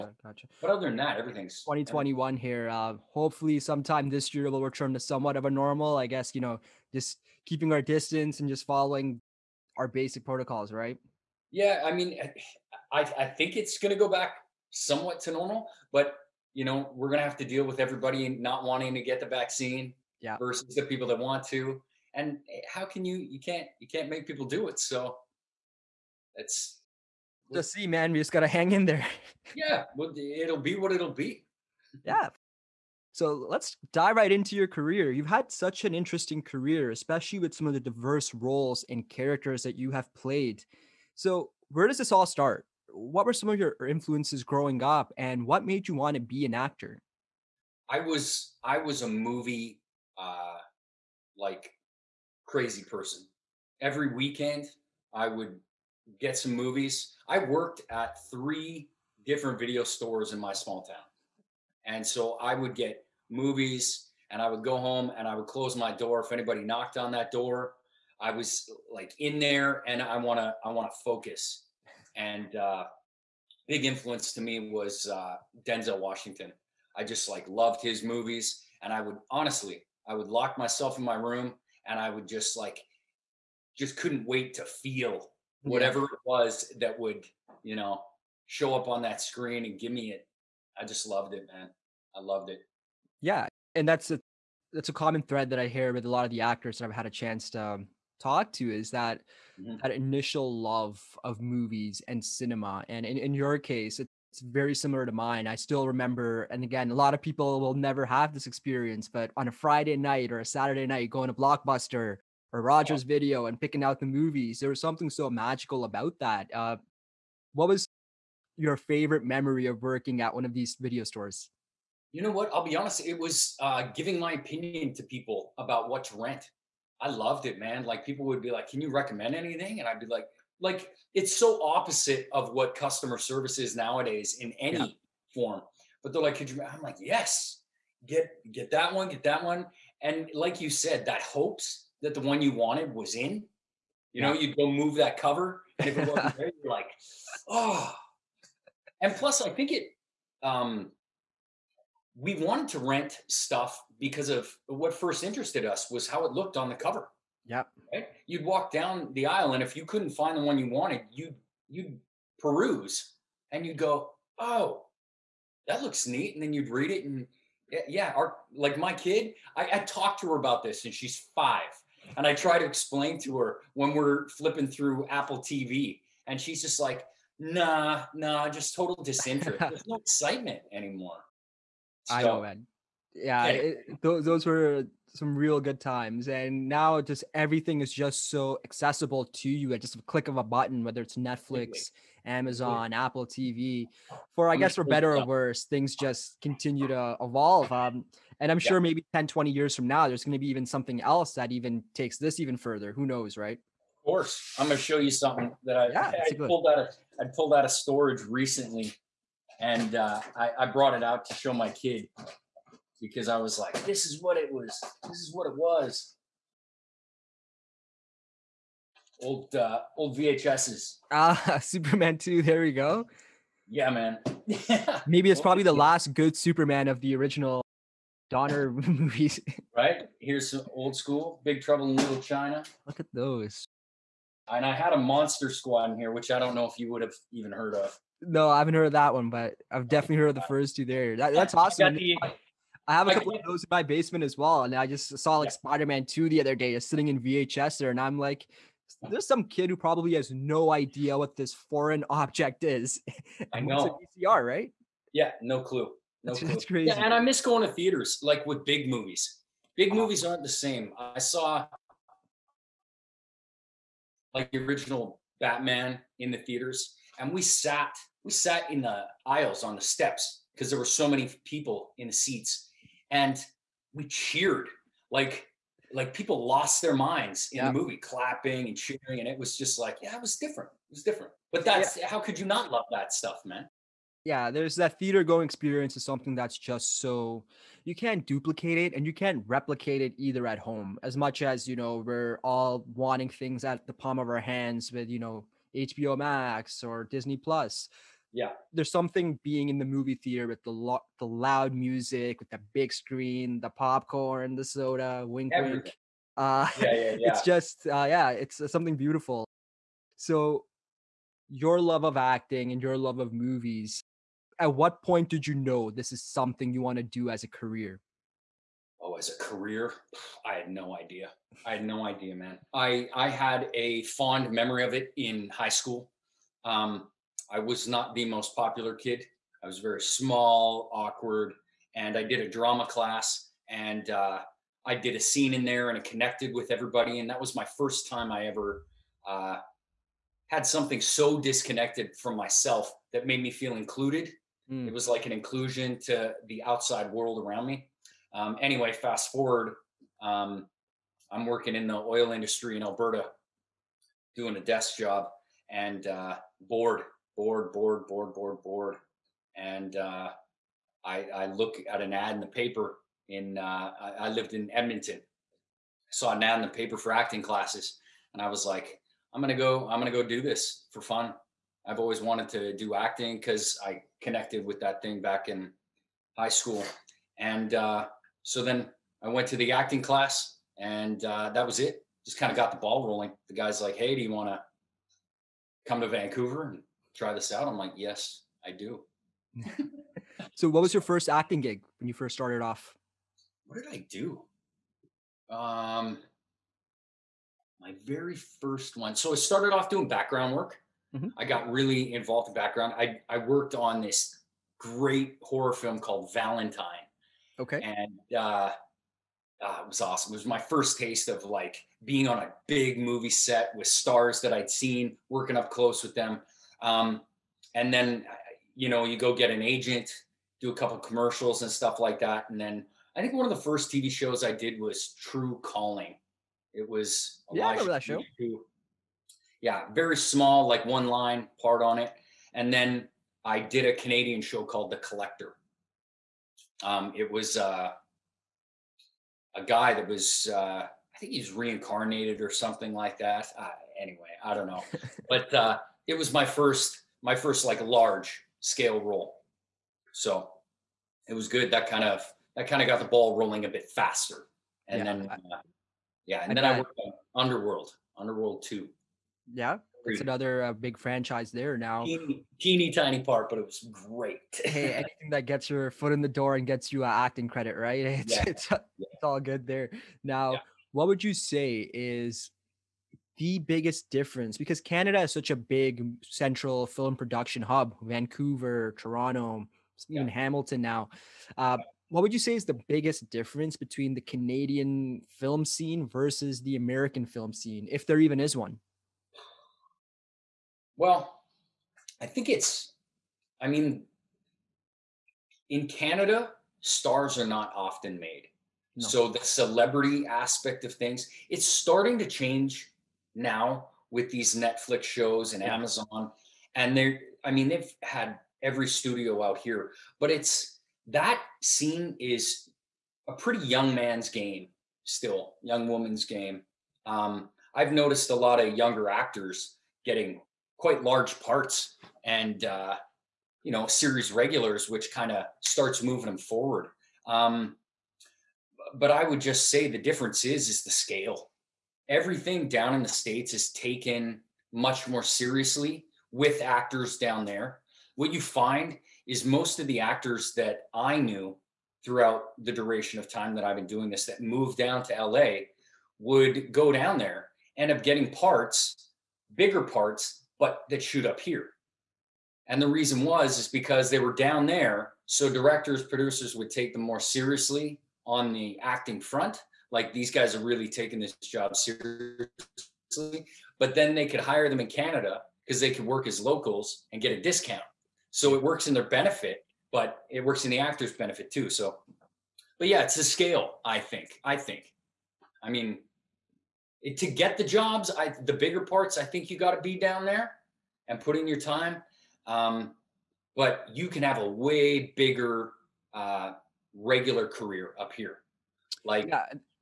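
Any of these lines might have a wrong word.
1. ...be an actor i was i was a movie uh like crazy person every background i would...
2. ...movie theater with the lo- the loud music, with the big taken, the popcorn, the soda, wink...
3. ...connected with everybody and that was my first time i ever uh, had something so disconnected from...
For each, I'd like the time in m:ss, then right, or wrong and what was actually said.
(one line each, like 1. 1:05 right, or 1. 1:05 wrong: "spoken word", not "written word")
1. 0:46 wrong: "weekend", not "background"
2. 4:59 wrong: "screen", not "taken"
3. 5:36 right.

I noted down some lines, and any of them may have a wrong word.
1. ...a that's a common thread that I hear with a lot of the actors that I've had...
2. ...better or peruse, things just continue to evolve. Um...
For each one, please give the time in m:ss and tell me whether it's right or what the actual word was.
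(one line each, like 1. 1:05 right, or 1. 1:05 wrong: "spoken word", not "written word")
1. 1:34 right
2. 3:14 wrong: "worse", not "peruse".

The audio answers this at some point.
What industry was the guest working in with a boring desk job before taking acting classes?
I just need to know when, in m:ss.
5:51.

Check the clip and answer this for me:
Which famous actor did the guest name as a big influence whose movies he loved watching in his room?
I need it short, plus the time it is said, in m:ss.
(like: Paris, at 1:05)
Denzel Washington, at 1:15.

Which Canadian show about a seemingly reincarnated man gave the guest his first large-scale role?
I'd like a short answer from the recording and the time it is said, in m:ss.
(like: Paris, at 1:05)
The Collector, at 7:14.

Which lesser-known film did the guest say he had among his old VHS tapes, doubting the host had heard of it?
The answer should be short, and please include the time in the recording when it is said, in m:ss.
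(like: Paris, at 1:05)
Monster Squad, at 3:54.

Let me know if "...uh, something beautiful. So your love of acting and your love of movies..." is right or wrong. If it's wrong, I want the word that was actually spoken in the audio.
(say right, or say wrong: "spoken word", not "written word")
right.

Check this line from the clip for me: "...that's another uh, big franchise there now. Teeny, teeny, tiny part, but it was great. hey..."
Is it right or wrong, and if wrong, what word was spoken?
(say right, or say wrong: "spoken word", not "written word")
right.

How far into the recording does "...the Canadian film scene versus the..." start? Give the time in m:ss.
8:04.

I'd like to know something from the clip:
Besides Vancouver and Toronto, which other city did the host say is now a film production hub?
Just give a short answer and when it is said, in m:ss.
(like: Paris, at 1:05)
Hamilton, at 8:00.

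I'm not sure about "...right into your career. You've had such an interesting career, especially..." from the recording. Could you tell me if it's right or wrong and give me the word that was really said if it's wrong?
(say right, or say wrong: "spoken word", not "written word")
right.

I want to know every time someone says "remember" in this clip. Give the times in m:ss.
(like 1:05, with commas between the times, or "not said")
1:45, 7:07.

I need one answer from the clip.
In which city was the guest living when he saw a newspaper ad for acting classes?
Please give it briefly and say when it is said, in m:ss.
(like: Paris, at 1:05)
Edmonton, at 6:04.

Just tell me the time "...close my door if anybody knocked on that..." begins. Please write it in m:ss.
1:05.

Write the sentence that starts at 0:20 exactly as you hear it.
versus the people that want to.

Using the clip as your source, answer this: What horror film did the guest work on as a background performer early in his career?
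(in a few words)
Valentine.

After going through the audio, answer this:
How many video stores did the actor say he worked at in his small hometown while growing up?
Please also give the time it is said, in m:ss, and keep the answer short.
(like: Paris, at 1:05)
3, at 0:58.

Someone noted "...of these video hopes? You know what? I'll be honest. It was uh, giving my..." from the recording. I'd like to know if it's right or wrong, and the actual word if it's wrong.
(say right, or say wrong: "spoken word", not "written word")
wrong: "stores", not "hopes".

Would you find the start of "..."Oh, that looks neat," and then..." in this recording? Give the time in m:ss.
2:44.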